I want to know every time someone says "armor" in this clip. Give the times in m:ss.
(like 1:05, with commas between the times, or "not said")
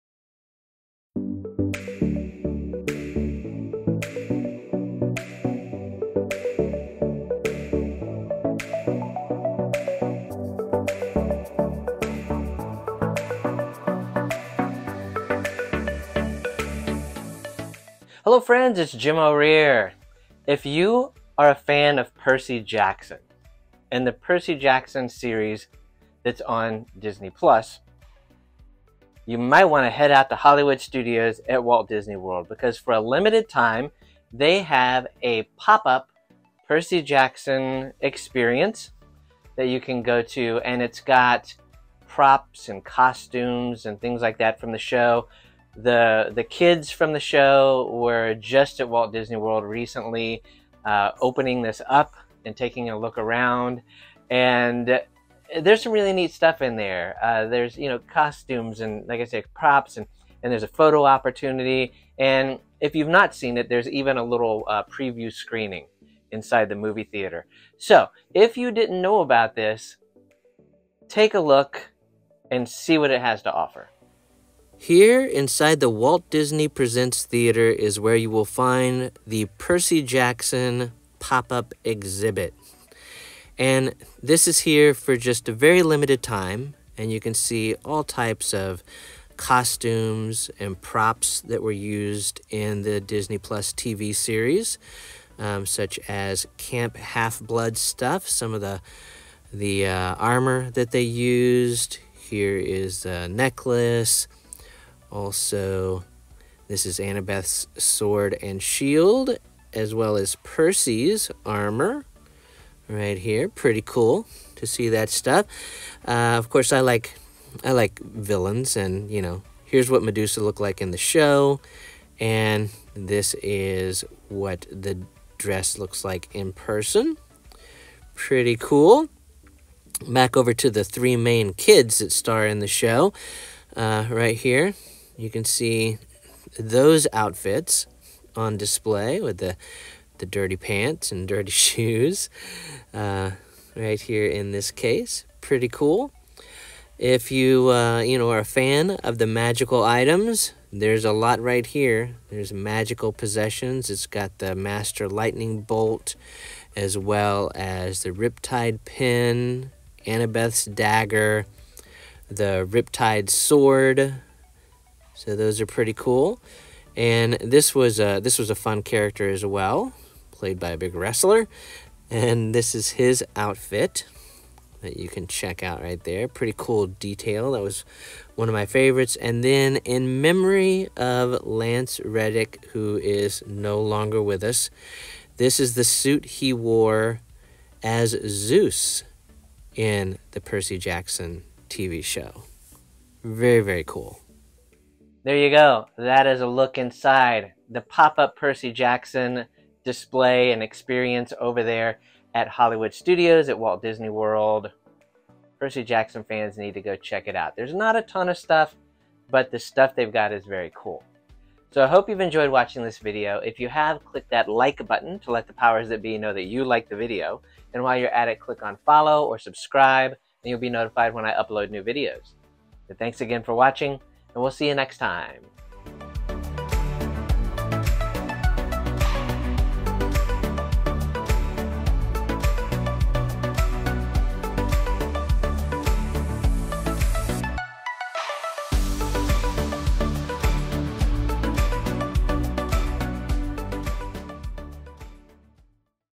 1:40, 1:51.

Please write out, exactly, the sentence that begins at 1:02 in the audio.
And if you've not seen it, there's even a little uh, preview screening inside the movie theater.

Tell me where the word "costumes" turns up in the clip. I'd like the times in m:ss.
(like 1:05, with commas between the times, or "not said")
0:42, 0:57, 1:29.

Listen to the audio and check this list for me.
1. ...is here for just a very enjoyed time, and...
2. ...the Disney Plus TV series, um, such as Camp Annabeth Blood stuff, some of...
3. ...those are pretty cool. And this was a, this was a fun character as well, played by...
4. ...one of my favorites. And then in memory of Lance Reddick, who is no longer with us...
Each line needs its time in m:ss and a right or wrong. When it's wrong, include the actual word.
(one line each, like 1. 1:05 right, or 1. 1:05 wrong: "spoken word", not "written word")
1. 1:24 wrong: "limited", not "enjoyed"
2. 1:32 wrong: "Half", not "Annabeth"
3. 2:45 right
4. 2:58 right.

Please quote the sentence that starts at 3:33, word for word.
If you have, click that like button to let the powers that be know that you like the video.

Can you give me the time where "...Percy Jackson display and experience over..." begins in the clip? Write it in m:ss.
3:18.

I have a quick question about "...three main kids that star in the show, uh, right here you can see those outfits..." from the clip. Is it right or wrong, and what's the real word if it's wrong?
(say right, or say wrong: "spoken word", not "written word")
right.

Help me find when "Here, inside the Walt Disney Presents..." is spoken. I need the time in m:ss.
1:14.